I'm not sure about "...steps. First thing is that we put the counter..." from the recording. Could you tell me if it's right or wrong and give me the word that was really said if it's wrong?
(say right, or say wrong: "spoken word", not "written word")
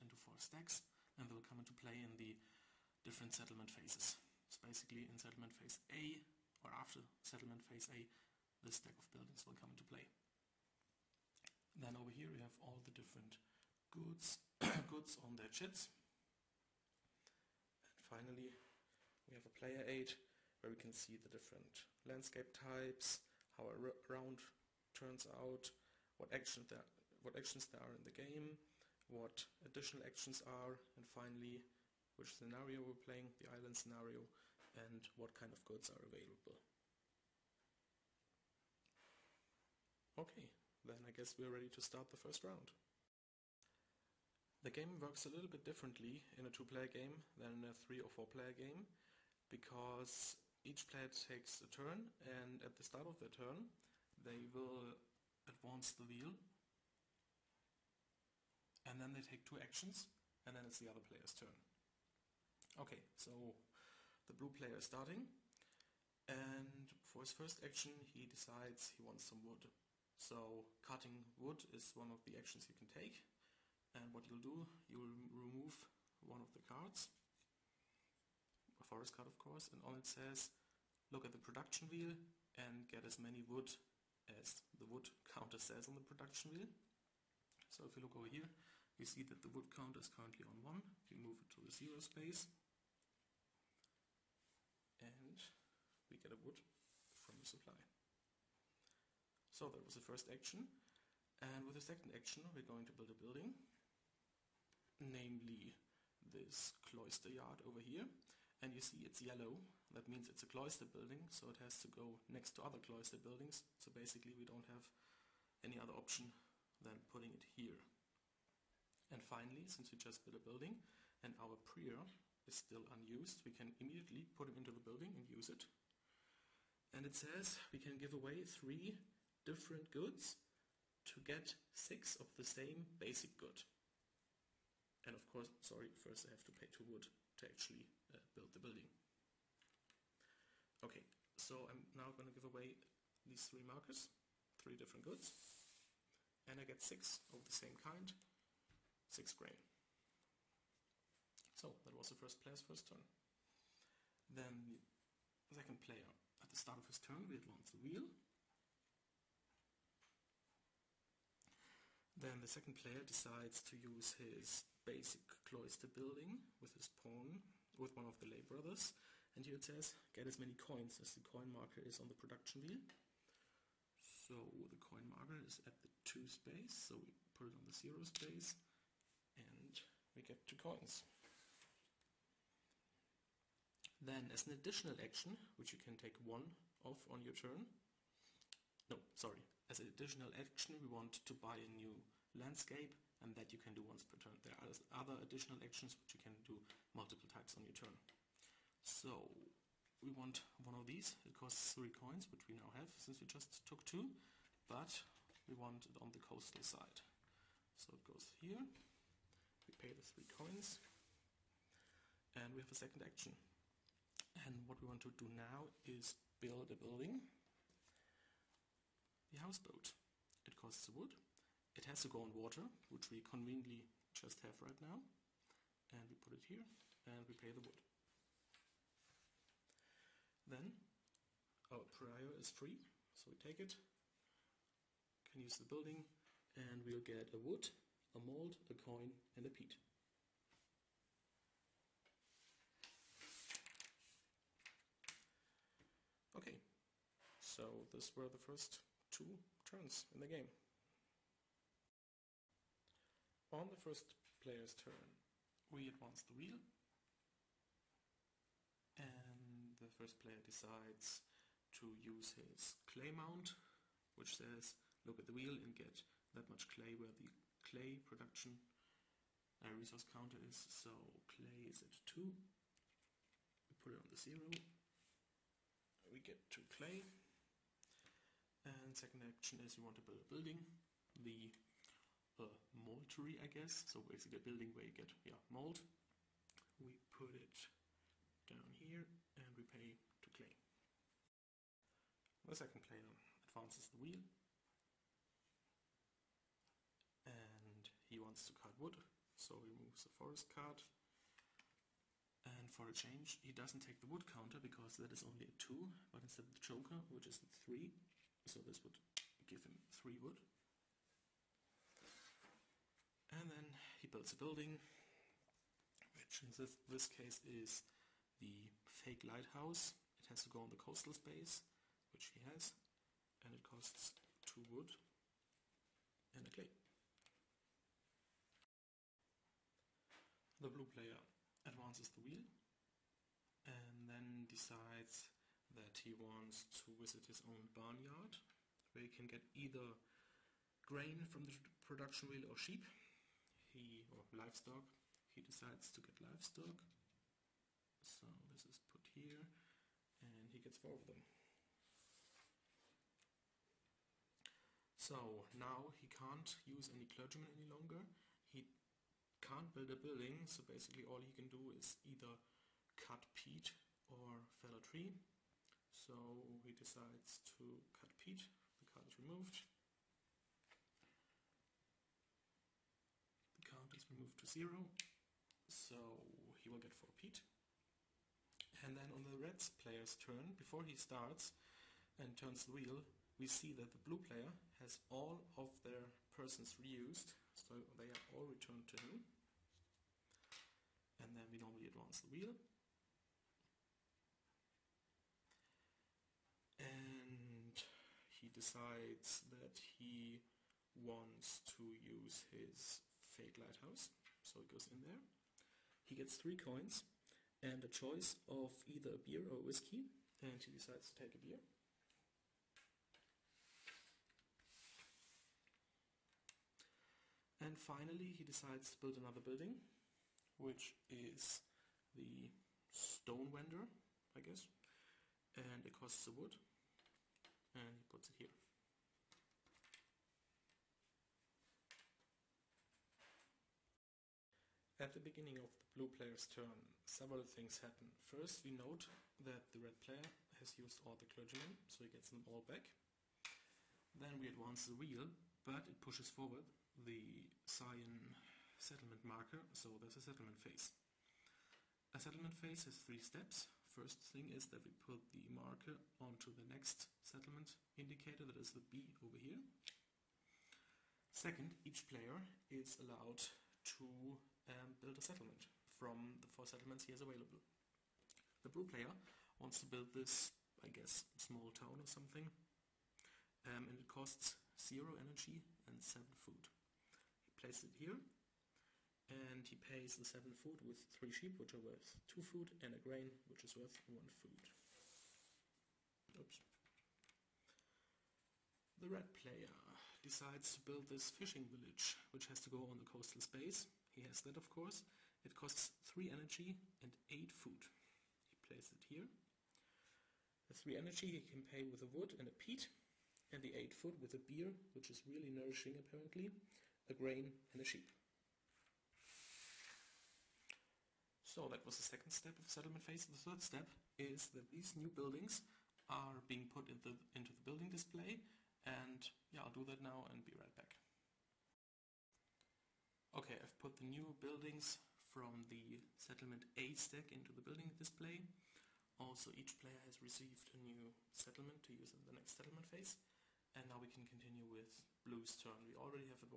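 wrong: "marker", not "counter".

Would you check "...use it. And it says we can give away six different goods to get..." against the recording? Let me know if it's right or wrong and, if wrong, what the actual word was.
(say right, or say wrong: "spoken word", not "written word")
wrong: "three", not "six".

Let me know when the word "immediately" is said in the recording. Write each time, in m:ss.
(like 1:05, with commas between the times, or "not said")
2:03.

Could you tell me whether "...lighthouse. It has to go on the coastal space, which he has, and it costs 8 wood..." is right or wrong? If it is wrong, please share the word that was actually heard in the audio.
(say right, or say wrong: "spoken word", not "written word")
wrong: "2", not "8".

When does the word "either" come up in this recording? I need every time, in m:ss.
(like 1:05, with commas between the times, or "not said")
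5:39, 6:02, 6:48.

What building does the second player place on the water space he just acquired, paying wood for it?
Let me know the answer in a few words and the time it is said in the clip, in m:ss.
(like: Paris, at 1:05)
houseboat, at 3:39.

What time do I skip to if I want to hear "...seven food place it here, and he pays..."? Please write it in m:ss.
7:56.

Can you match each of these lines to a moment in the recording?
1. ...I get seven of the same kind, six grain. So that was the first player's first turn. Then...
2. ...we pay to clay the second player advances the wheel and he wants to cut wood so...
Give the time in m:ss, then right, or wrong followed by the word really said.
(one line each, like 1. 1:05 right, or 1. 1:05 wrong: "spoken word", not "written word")
1. 2:26 wrong: "six", not "seven"
2. 4:49 right.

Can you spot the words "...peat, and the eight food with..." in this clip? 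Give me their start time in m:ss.
8:22.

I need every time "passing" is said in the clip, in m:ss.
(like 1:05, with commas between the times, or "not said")
not said.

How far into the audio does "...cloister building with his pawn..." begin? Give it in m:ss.
2:45.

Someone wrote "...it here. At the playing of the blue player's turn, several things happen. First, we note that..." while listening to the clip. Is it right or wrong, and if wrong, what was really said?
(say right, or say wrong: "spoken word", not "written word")
wrong: "beginning", not "playing".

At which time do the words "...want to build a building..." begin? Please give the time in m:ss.
4:39.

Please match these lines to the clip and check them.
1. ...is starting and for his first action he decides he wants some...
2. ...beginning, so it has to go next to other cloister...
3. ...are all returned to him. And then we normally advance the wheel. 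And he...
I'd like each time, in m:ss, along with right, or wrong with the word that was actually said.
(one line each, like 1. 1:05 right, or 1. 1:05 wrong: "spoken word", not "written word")
1. 1:04 right
2. 1:50 wrong: "building", not "beginning"
3. 6:28 right.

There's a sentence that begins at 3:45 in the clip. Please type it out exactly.
And we put it here, and we pay the wood.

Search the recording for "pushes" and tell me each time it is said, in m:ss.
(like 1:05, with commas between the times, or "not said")
7:26.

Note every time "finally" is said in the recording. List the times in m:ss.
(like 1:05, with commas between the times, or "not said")
0:17, 0:31, 1:59, 6:57.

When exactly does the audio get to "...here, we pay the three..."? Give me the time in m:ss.
3:28.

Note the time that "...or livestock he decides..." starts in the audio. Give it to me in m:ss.
5:44.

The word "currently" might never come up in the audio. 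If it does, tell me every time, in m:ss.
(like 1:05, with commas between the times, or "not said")
1:30.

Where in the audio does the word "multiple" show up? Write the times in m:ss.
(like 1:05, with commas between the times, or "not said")
3:16.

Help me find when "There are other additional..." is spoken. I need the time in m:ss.
3:14.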